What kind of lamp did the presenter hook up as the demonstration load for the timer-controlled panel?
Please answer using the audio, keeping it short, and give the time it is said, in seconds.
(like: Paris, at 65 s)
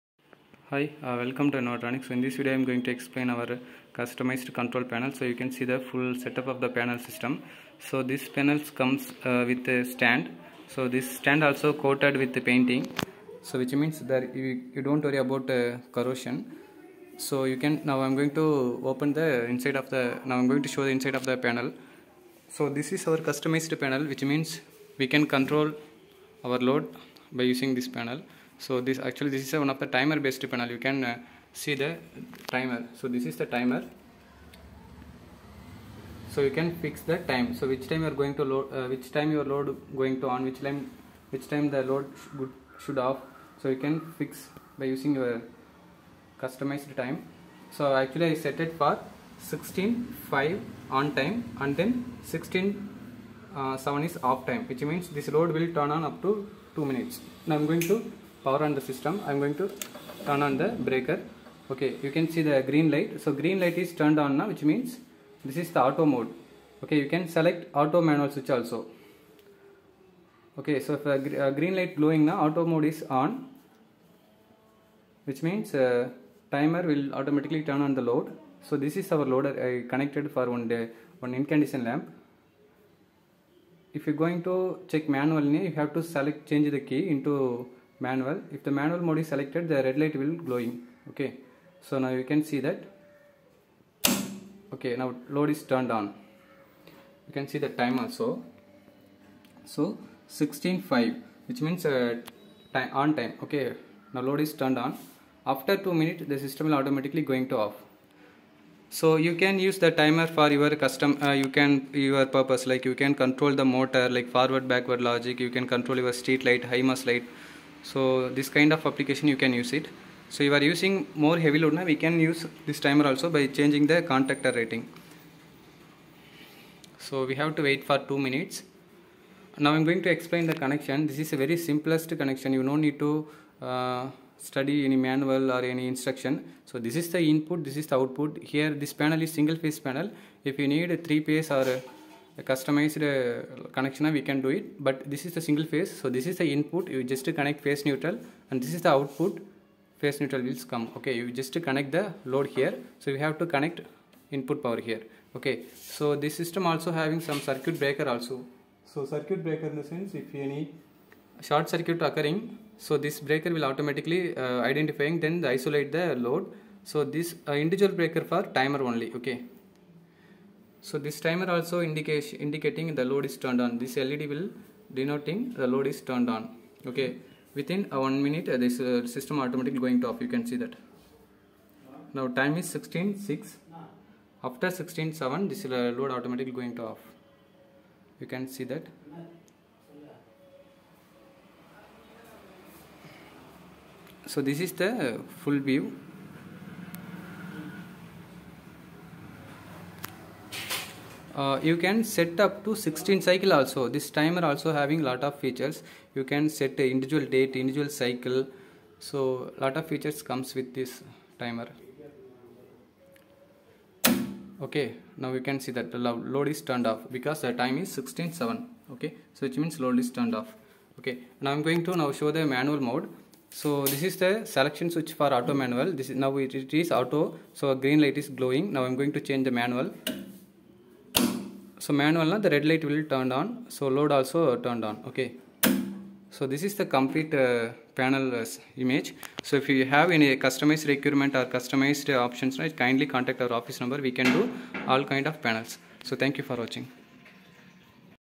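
Incandescent lamp, at 81 s.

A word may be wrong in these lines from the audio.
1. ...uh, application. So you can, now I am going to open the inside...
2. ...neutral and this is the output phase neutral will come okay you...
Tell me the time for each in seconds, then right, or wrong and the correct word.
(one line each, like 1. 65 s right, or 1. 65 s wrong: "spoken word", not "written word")
1. 15 s wrong: "corrosion", not "application"
2. 147 s right.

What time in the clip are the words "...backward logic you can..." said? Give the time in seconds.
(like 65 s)
114 s.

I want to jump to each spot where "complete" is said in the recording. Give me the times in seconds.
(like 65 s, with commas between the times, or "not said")
236 s.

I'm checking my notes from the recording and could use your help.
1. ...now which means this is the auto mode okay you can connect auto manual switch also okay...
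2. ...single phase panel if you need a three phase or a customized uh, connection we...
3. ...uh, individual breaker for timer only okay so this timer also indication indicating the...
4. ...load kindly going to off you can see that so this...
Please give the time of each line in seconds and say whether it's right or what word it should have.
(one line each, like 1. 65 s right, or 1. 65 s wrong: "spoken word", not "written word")
1. 64 s wrong: "select", not "connect"
2. 139 s right
3. 167 s right
4. 185 s wrong: "automatically", not "kindly".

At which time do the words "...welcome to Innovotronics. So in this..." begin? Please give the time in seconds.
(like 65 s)
1 s.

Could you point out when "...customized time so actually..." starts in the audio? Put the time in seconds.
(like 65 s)
46 s.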